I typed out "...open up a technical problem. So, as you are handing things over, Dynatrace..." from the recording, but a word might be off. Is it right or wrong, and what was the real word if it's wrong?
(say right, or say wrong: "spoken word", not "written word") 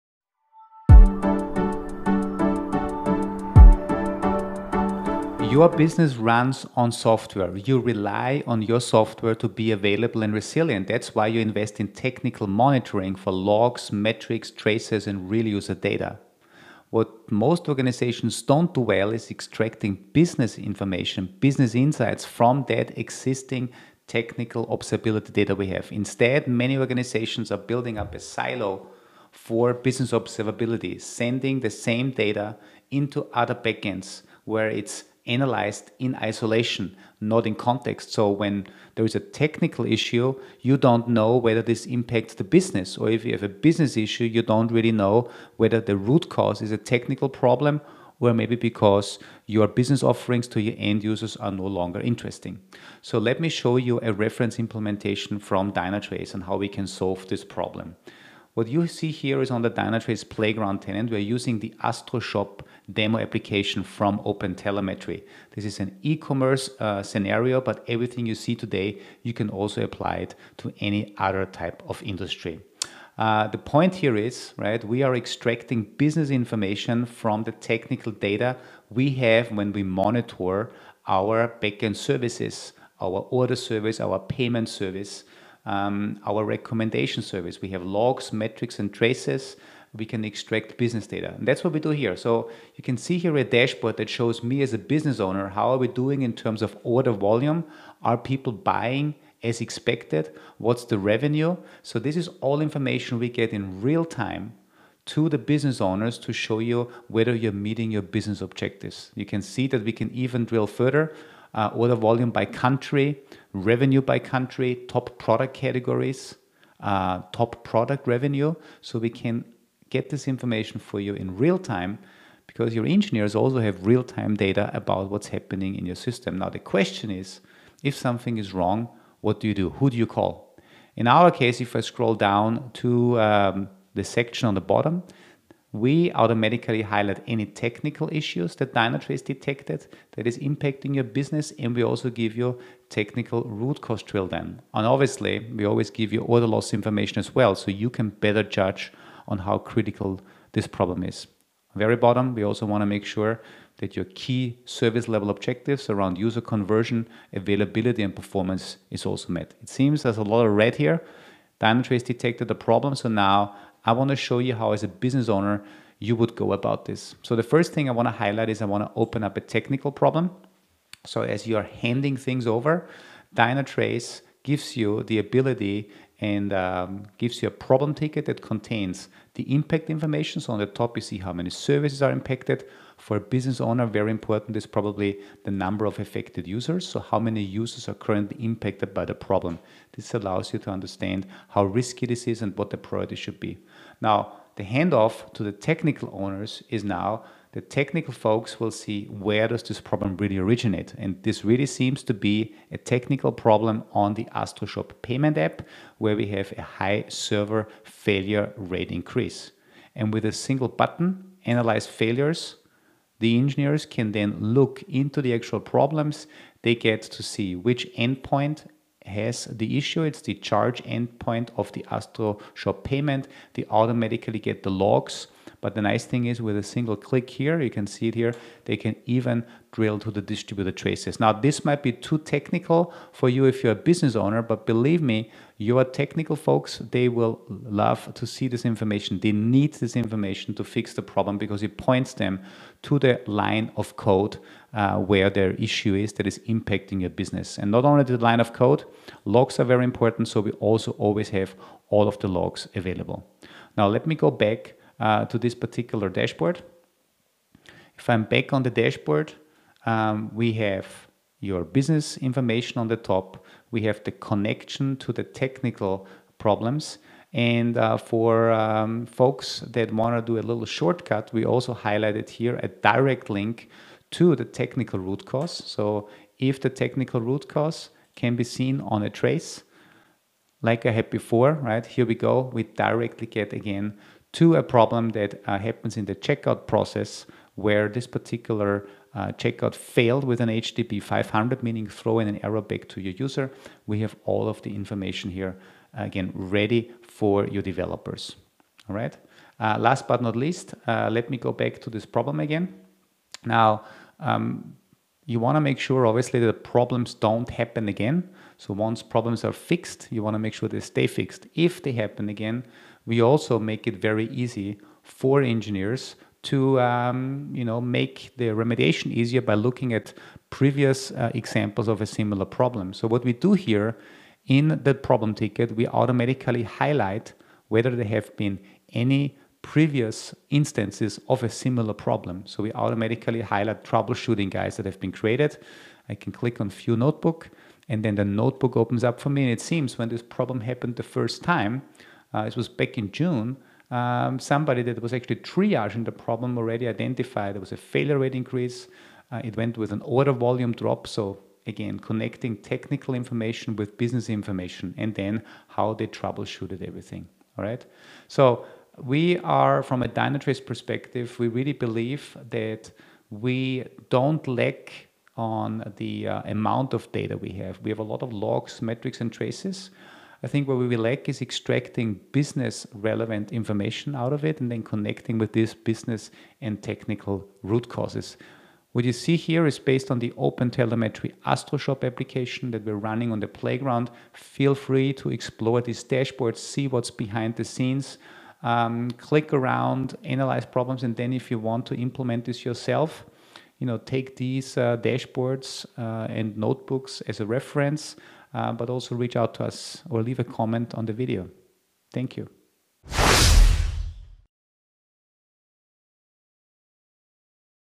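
right.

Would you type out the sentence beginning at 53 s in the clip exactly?
So let me show you a reference implementation from Dynatrace and how we can solve this problem.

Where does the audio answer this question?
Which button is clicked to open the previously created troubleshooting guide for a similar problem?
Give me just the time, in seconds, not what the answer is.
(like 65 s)
336 s.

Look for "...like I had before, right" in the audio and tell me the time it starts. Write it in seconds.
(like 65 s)
280 s.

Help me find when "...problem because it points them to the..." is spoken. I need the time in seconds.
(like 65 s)
241 s.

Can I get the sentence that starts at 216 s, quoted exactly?
They get to see which endpoint has the issue.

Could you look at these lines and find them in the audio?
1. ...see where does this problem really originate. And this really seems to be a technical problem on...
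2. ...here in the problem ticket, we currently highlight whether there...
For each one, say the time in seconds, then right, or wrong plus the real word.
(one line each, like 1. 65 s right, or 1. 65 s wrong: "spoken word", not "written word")
1. 198 s right
2. 323 s wrong: "automatically", not "currently".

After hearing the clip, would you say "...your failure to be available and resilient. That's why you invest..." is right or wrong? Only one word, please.
wrong.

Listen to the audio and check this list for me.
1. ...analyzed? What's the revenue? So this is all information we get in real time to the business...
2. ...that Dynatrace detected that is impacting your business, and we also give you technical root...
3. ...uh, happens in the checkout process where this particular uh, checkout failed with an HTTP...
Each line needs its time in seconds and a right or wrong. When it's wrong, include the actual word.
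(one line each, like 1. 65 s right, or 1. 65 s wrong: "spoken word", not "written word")
1. 99 s wrong: "expected", not "analyzed"
2. 138 s right
3. 285 s right.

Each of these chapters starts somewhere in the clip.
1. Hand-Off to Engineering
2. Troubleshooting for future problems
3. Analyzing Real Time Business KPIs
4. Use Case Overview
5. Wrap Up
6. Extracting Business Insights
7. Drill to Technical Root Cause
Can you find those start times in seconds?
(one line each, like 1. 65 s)
1. 206 s
2. 305 s
3. 93 s
4. 58 s
5. 364 s
6. 75 s
7. 161 s.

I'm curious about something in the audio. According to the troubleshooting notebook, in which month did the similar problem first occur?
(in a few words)
June.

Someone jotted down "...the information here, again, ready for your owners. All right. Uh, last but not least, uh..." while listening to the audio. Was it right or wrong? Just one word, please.
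wrong.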